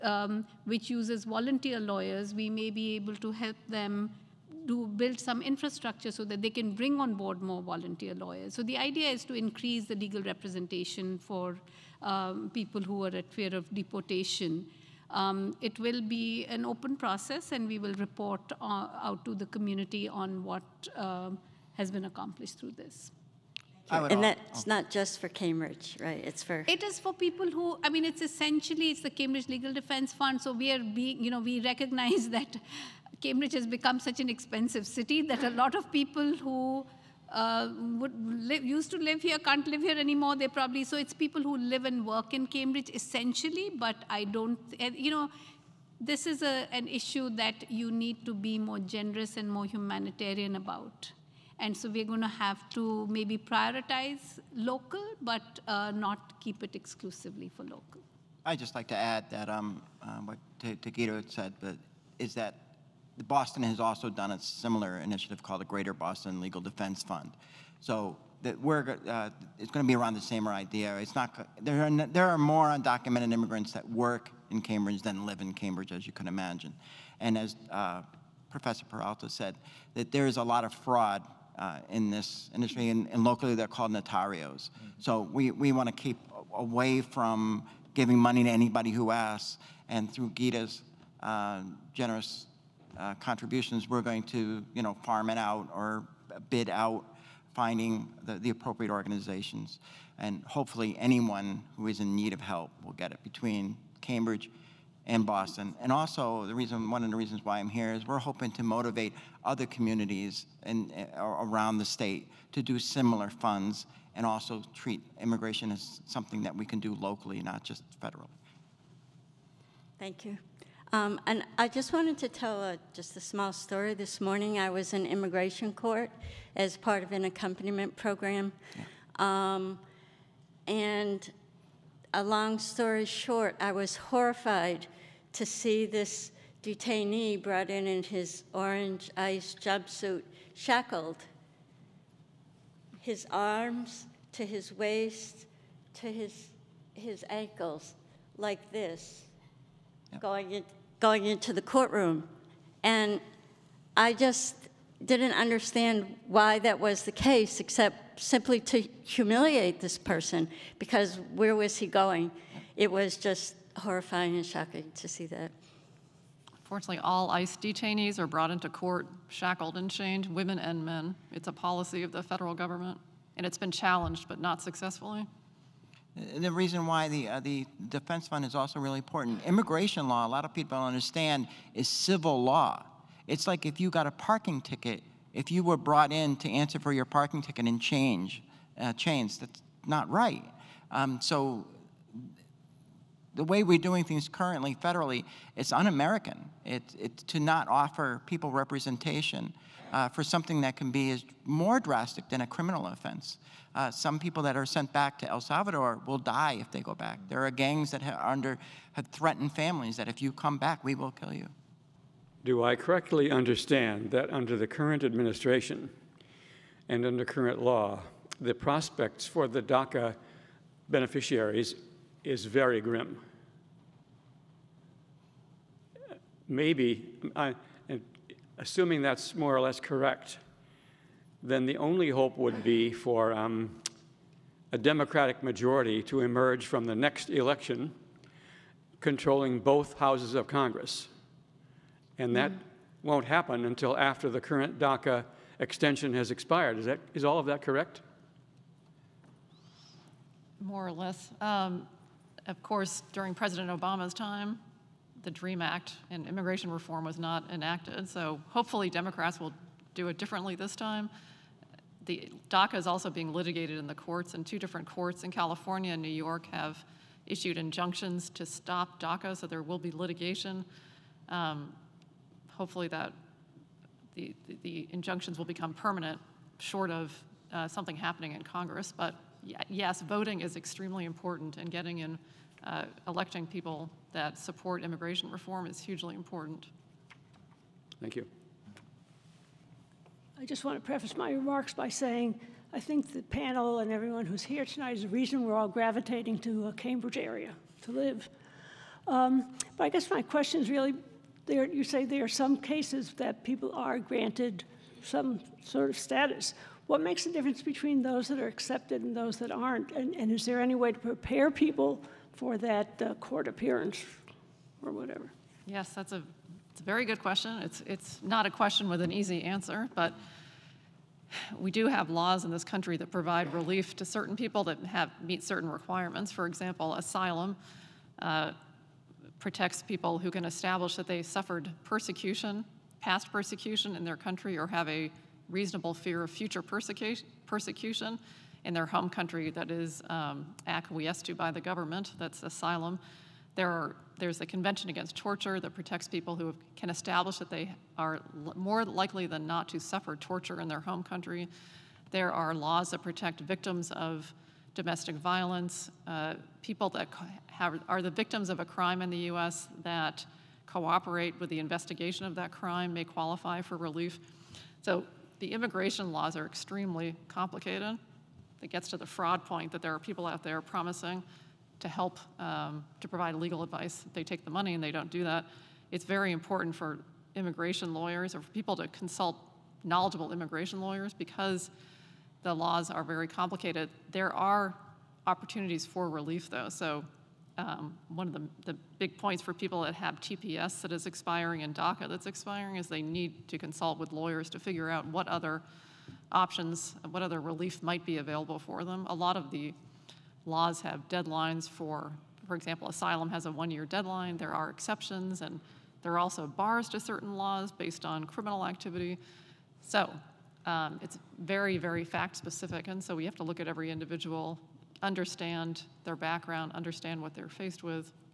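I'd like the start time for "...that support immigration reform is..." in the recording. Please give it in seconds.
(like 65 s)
284 s.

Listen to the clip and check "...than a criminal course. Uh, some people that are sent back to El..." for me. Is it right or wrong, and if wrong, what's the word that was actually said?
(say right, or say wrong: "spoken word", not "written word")
wrong: "offense", not "course".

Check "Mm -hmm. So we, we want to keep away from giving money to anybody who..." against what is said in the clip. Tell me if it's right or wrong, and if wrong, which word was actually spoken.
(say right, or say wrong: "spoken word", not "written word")
right.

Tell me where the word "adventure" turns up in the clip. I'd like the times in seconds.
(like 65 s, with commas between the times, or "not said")
not said.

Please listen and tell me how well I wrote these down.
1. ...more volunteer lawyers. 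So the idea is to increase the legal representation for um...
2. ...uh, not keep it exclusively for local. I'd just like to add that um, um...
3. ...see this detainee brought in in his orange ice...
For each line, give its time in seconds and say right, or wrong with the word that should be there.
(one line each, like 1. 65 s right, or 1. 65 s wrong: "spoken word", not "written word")
1. 7 s right
2. 55 s right
3. 135 s right.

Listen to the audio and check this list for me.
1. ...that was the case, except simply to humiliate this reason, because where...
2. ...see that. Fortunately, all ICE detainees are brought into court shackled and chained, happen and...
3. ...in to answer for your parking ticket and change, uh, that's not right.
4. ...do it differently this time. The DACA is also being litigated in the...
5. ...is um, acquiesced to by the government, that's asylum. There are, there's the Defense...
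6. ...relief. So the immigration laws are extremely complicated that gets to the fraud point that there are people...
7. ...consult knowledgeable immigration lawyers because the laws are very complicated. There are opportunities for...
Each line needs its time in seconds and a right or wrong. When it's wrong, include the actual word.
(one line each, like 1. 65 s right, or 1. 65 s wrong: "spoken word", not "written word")
1. 156 s wrong: "person", not "reason"
2. 165 s wrong: "women", not "happen"
3. 186 s right
4. 259 s right
5. 339 s wrong: "Convention", not "Defense"
6. 363 s right
7. 378 s right.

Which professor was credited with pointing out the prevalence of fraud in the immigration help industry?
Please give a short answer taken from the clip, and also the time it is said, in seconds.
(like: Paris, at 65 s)
Professor Peralta, at 78 s.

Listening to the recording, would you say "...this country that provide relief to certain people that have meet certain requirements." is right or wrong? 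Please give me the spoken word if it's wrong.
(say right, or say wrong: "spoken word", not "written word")
right.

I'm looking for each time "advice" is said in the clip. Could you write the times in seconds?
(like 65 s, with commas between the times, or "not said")
373 s.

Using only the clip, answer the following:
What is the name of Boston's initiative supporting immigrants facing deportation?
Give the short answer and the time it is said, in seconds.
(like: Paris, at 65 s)
Greater Boston Legal Defense Fund, at 65 s.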